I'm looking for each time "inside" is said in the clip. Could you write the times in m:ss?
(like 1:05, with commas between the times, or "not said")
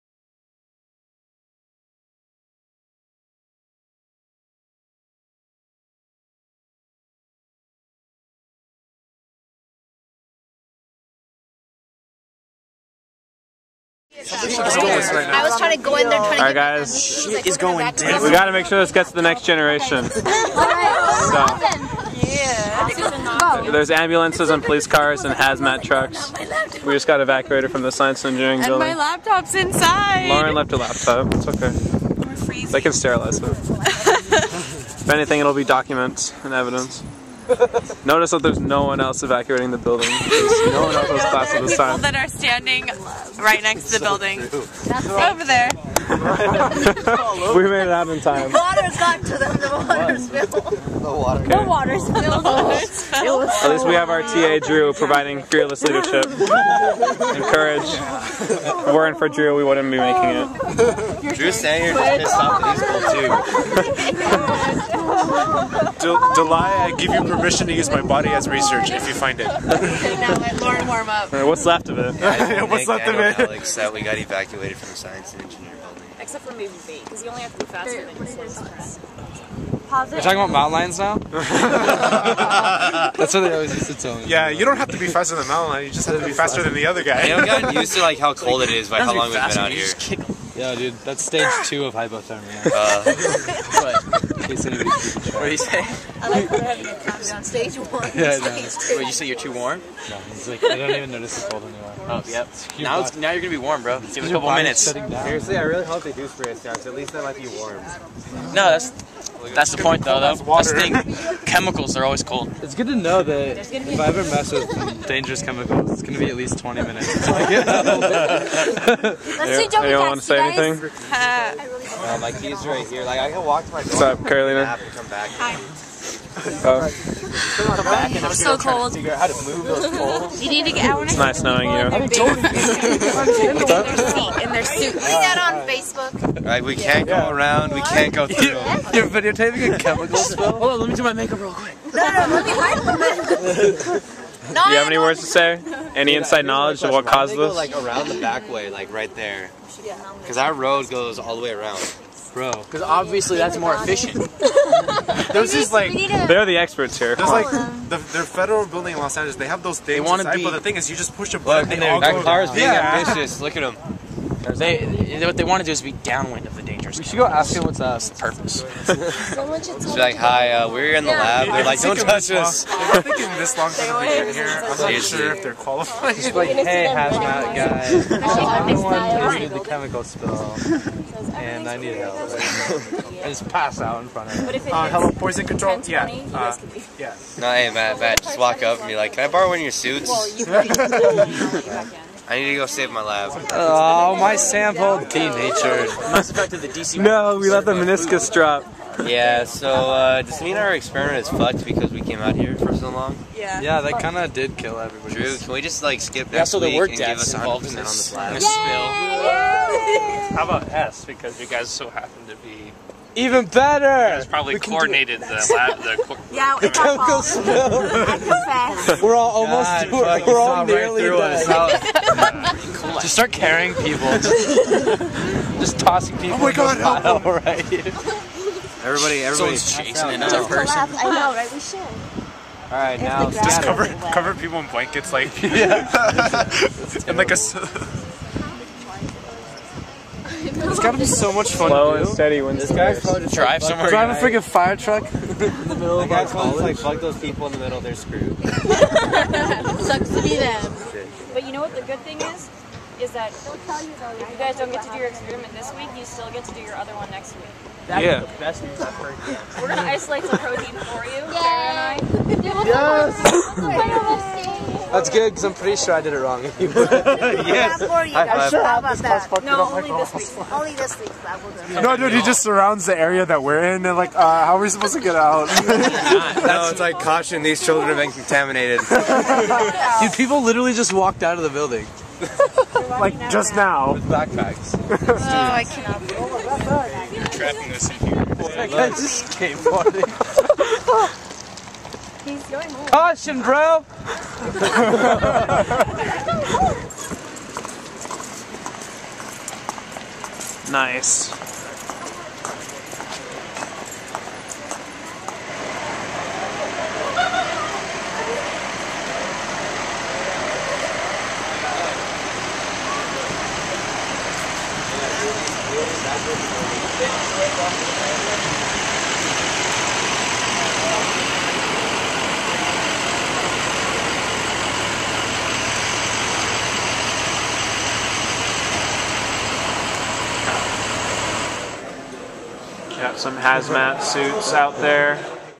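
0:29, 2:26.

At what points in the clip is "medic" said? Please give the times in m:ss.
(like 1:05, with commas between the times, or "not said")
not said.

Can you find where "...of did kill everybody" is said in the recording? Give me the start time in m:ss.
3:24.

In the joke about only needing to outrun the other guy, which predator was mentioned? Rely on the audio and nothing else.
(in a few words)
Mountain lion.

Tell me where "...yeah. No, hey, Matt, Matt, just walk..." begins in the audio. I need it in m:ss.
3:06.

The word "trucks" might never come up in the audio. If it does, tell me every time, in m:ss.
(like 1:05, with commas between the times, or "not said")
0:25, 4:04.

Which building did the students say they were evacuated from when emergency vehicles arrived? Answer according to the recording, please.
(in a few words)
Science engineering building.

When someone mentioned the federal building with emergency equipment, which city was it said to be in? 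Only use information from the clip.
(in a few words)
Los Angeles.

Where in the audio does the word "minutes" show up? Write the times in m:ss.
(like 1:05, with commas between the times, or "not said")
1:44, 1:56.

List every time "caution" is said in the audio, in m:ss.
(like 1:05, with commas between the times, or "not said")
4:36, 4:52.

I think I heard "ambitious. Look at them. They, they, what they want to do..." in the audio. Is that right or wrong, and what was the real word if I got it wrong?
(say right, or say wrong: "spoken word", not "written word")
right.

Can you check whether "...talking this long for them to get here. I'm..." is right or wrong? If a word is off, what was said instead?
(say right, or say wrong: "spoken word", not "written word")
wrong: "thinking", not "talking".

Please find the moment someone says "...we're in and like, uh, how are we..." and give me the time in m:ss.
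4:33.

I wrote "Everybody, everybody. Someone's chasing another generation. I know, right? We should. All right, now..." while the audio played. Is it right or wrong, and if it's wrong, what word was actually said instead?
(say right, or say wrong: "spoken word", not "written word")
wrong: "person", not "generation".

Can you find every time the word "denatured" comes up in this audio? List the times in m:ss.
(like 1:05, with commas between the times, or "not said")
3:14.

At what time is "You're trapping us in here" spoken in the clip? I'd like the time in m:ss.
4:47.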